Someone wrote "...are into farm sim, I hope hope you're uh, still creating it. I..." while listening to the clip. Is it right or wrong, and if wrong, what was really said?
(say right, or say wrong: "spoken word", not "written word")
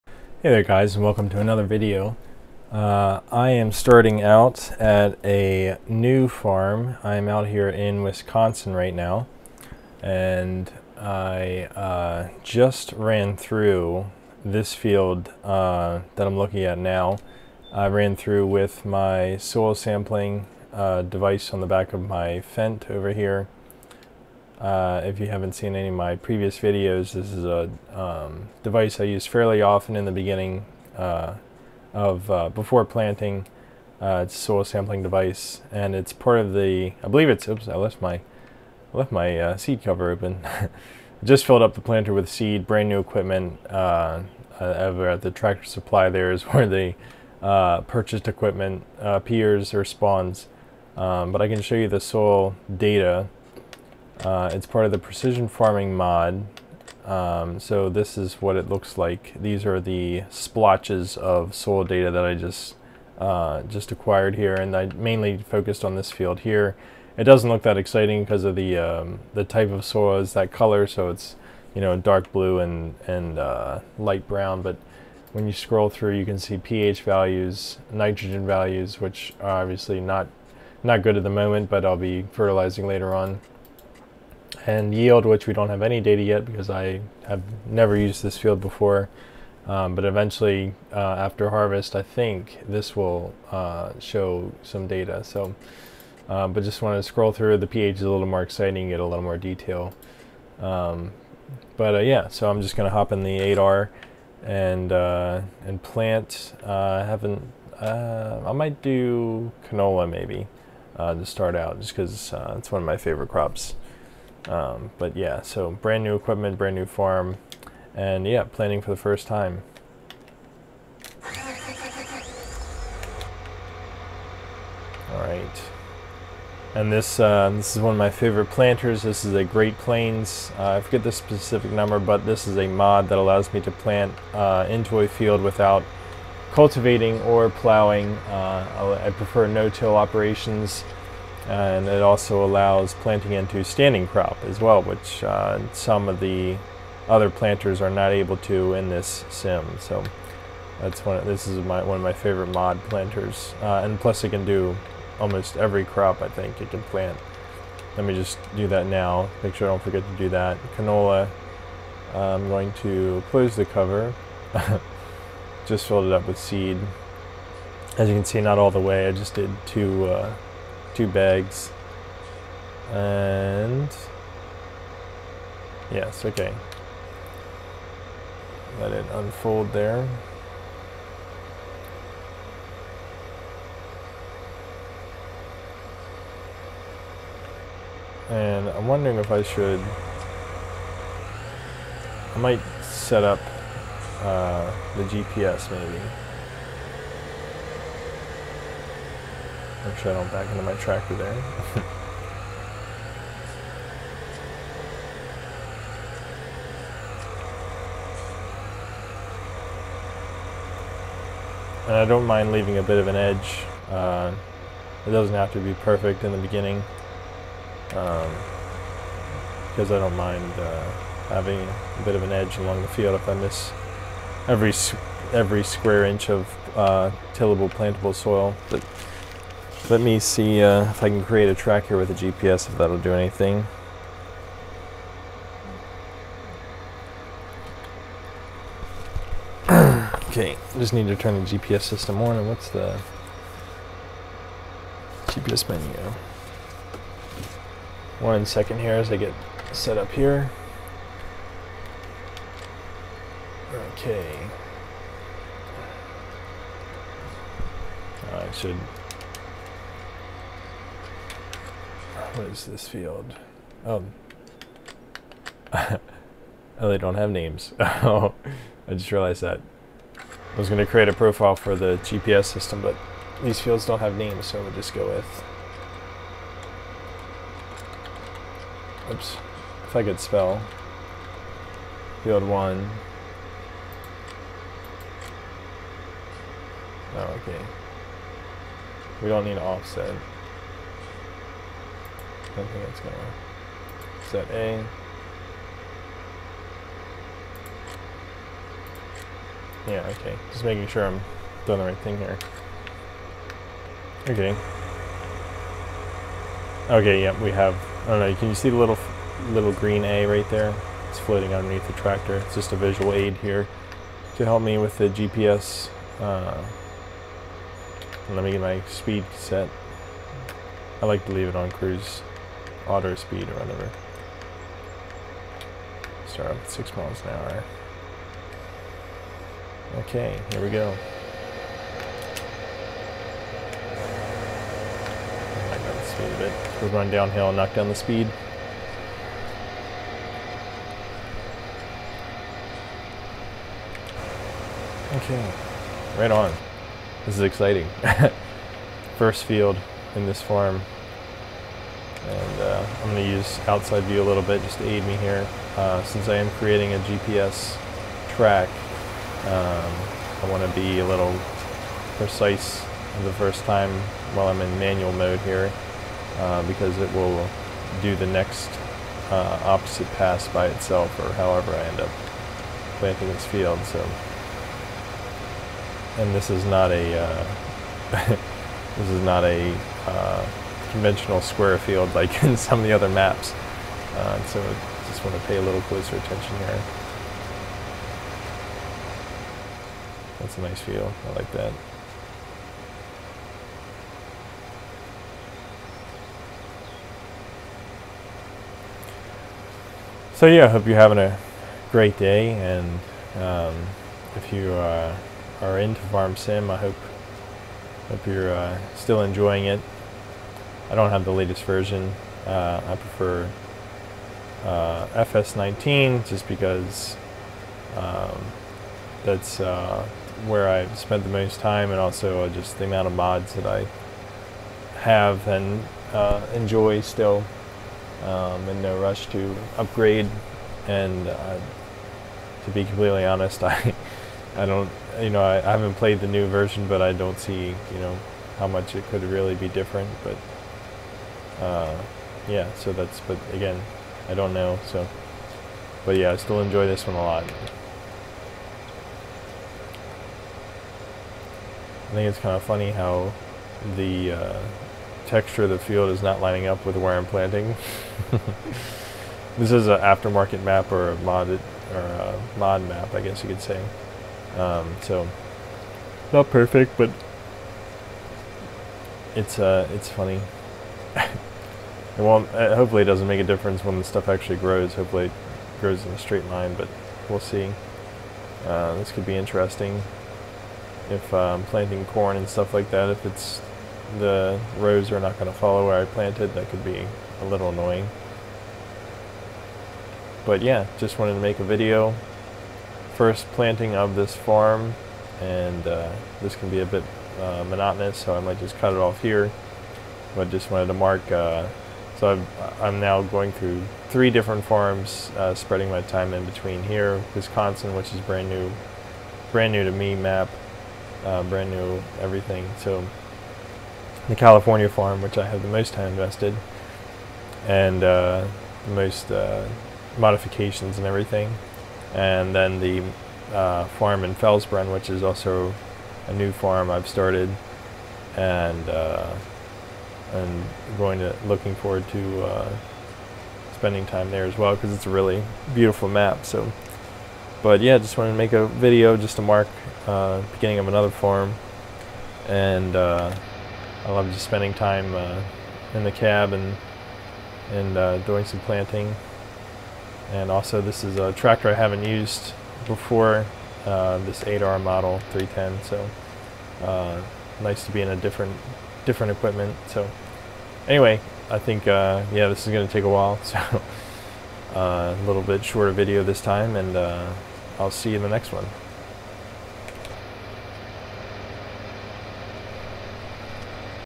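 wrong: "enjoying", not "creating".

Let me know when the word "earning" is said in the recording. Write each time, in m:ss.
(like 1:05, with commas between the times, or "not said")
not said.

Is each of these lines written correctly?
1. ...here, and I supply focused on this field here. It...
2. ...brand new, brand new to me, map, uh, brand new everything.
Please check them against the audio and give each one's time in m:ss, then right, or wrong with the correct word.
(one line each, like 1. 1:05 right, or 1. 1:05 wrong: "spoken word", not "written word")
1. 1:04 wrong: "mainly", not "supply"
2. 8:28 right.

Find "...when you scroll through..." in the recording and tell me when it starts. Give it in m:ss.
1:15.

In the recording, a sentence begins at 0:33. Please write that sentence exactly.
Uh, it's a soil sampling device, and it's part of the.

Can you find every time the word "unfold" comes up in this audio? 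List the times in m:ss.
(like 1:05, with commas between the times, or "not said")
2:59.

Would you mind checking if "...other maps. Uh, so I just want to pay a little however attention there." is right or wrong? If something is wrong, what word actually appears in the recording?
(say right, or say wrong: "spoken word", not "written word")
wrong: "closer", not "however".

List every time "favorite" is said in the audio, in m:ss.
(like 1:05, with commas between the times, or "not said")
1:52, 2:08, 2:32.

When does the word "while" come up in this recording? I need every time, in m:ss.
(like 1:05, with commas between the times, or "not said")
6:04, 9:23.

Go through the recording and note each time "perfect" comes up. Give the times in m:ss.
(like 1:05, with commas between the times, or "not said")
3:35, 7:46.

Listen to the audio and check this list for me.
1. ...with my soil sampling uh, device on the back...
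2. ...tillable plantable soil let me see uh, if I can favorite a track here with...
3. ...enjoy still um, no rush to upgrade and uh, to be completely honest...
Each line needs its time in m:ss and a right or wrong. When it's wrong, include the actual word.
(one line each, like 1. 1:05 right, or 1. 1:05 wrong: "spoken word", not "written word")
1. 0:18 right
2. 3:47 wrong: "create", not "favorite"
3. 7:06 right.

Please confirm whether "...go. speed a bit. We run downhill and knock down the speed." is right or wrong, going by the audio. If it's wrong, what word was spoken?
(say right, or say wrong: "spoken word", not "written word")
right.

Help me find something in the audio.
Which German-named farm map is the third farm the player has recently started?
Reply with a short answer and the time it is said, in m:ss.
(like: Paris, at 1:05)
Felsbrunn, at 8:44.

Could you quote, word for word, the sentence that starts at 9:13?
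Uh, this 8R model 310, so nice to be in a different different equipment.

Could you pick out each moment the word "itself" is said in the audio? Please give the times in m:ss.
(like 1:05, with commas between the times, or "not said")
6:10.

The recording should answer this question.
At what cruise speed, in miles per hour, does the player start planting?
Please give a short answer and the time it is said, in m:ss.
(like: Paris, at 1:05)
6, at 5:26.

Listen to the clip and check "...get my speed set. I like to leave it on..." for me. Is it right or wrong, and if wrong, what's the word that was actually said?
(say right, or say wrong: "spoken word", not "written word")
right.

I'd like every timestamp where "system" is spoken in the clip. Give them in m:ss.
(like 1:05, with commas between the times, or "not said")
4:01, 4:32.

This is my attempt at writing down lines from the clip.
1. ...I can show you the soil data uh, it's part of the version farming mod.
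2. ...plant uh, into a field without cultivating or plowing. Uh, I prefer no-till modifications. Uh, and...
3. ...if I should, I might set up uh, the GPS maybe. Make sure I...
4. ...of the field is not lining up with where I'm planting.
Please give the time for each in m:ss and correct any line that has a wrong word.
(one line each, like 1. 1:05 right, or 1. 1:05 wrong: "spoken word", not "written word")
1. 0:51 wrong: "precision", not "version"
2. 2:13 wrong: "operations", not "modifications"
3. 3:09 right
4. 7:35 right.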